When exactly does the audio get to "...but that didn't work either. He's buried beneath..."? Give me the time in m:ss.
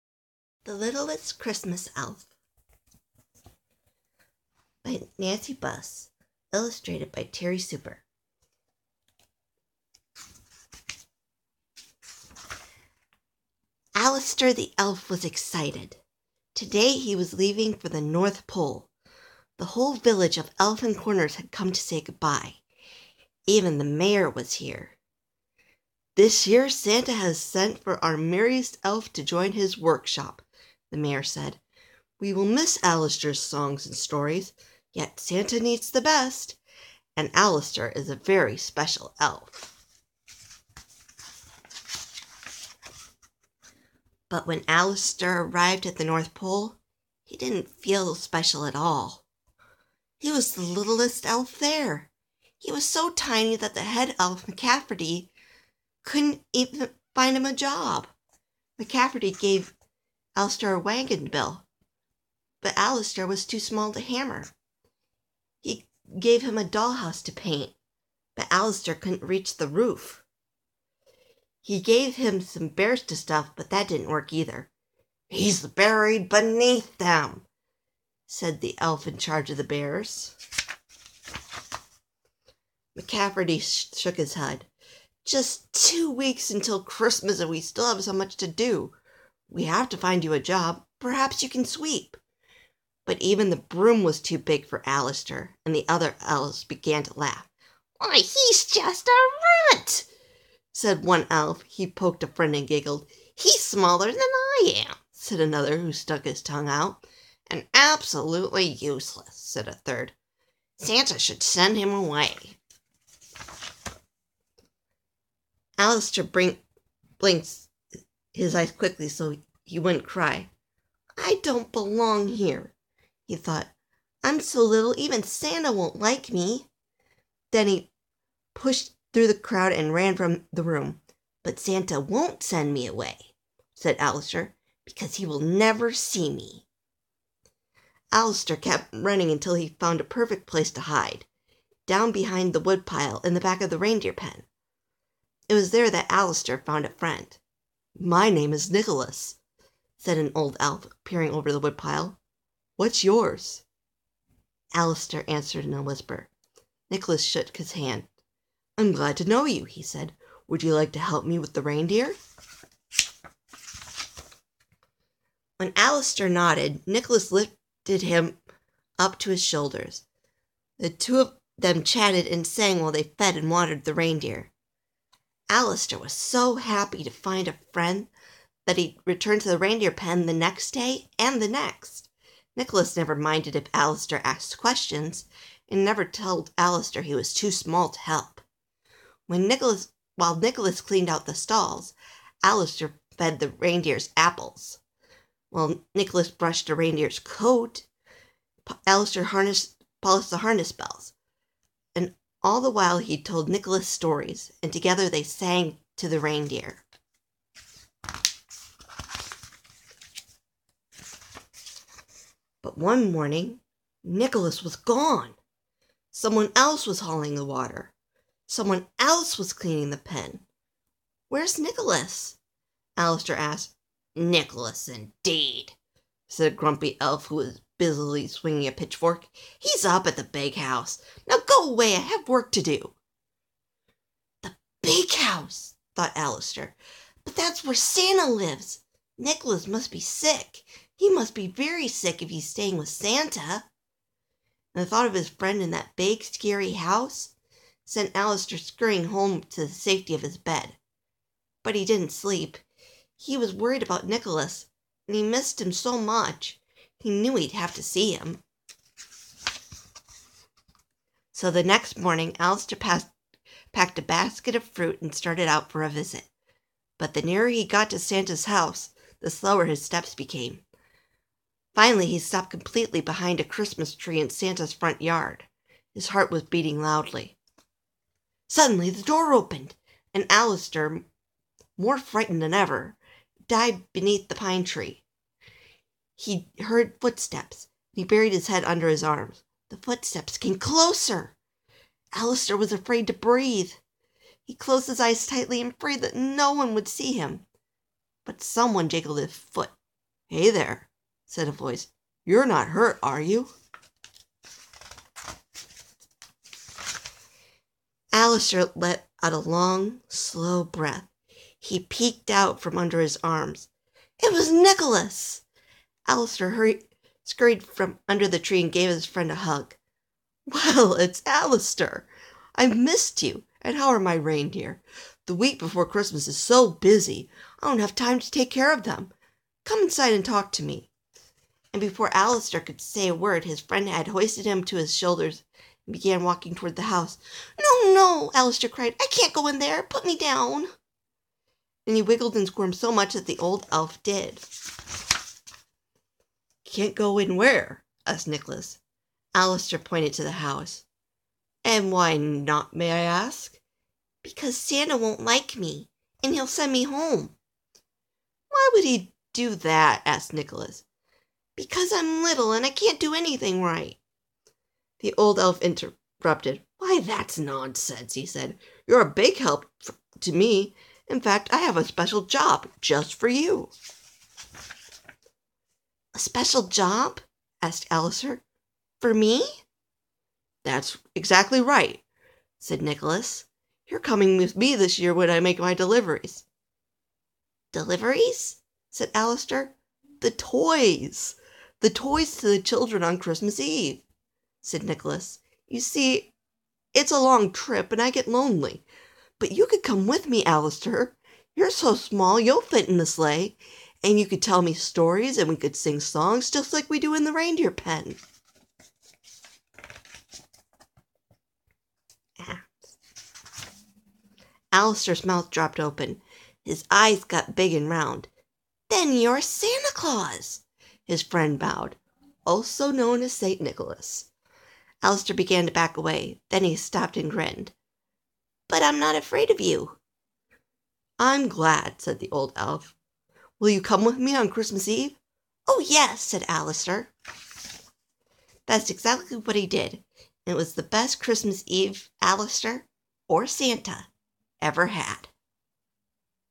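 1:13.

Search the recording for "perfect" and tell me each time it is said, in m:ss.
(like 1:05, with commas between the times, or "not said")
2:20.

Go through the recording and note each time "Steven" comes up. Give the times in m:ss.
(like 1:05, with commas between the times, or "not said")
not said.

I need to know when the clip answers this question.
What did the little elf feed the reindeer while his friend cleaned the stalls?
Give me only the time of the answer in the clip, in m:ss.
3:14.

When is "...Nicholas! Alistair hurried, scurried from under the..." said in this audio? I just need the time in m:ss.
5:14.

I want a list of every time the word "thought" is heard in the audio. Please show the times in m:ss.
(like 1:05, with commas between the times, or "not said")
2:03, 3:55, 4:04.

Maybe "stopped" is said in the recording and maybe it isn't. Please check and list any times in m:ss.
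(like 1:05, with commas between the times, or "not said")
4:32, 7:06.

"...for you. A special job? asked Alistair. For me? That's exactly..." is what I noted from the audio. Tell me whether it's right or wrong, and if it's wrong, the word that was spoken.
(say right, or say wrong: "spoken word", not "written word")
right.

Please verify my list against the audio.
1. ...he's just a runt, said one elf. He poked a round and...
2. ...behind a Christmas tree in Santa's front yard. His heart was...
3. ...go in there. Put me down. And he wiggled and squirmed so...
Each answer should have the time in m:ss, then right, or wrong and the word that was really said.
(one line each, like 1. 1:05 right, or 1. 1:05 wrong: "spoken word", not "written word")
1. 1:38 wrong: "friend", not "round"
2. 4:33 right
3. 5:39 right.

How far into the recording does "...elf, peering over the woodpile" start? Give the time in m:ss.
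2:30.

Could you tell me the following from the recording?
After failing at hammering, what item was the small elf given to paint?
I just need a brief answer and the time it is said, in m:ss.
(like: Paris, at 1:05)
A dollhouse, at 1:06.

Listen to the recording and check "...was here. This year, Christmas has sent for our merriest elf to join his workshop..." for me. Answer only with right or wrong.
wrong.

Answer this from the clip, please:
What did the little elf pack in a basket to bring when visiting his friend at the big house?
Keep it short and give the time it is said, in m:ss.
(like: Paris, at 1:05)
Fruit, at 4:24.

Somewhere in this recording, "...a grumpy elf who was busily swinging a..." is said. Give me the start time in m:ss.
3:46.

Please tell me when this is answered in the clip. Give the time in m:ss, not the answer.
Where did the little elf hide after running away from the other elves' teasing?
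2:22.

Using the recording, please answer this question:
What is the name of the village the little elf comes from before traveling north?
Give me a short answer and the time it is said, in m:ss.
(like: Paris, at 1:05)
Elfin Corners, at 0:20.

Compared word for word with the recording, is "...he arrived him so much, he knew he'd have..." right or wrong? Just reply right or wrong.
wrong.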